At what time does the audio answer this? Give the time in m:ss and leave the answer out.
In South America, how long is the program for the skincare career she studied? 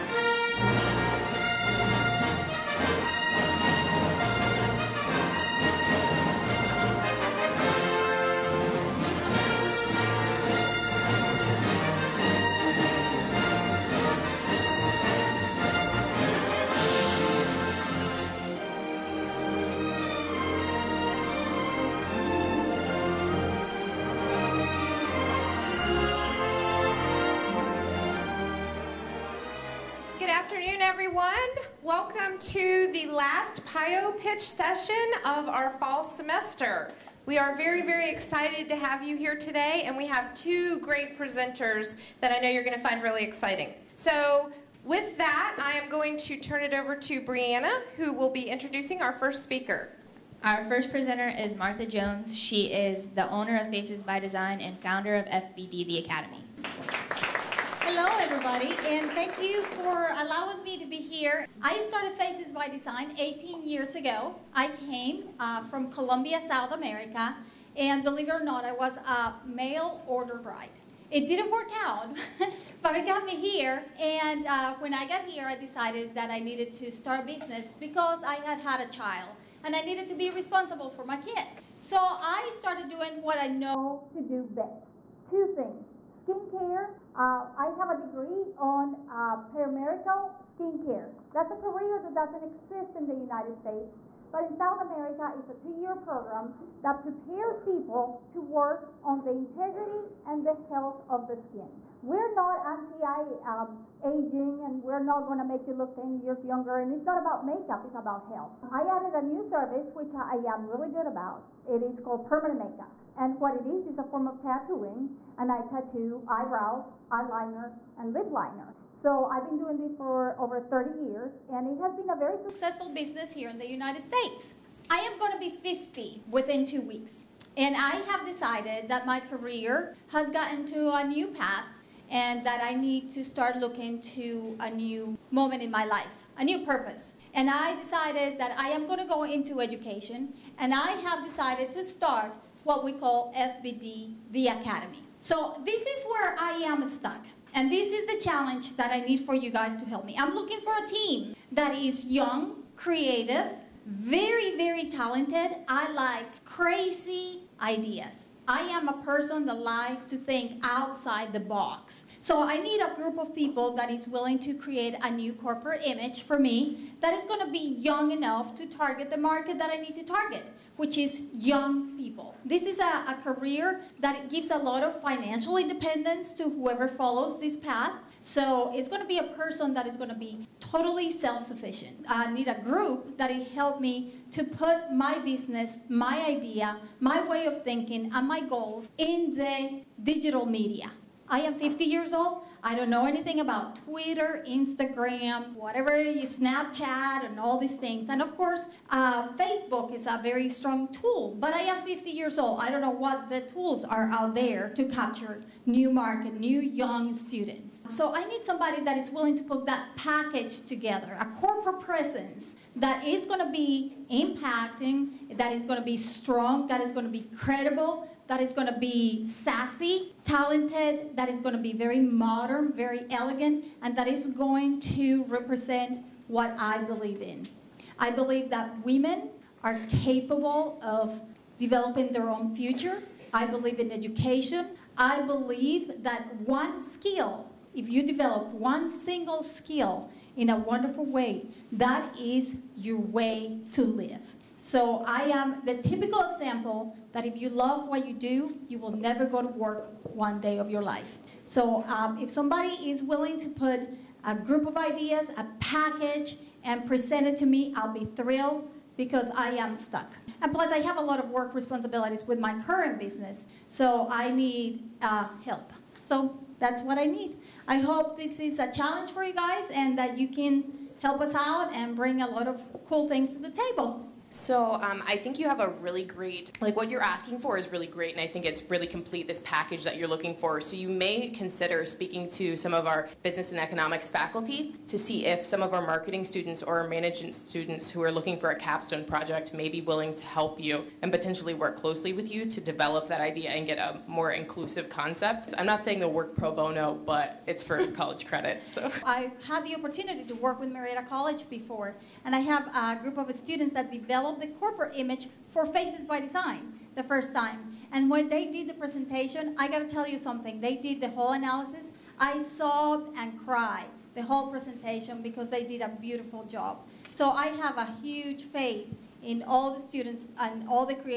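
1:35.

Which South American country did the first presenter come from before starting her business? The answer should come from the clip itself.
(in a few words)
Colombia.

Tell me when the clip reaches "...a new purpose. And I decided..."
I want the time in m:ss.
2:16.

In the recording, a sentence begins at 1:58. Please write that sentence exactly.
So I've been doing this for over 30 years, and it has been a very successful business here in the United States.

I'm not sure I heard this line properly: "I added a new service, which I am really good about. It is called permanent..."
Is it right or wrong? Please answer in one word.
right.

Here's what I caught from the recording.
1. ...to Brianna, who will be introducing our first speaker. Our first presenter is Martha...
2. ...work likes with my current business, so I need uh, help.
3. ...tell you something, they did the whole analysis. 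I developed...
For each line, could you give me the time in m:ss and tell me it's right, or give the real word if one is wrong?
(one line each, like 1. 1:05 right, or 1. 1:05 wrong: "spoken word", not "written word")
1. 0:46 right
2. 4:21 wrong: "responsibilities", not "likes"
3. 5:09 wrong: "sobbed", not "developed".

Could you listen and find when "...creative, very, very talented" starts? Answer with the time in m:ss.
2:32.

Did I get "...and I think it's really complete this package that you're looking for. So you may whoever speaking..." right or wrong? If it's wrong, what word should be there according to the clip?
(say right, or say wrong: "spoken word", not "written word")
wrong: "consider", not "whoever".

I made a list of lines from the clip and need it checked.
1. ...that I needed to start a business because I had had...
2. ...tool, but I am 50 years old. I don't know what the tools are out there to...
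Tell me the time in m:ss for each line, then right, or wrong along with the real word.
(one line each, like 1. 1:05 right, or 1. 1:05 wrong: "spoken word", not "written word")
1. 1:16 right
2. 3:20 right.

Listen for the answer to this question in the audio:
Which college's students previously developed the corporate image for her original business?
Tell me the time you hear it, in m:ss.
5:00.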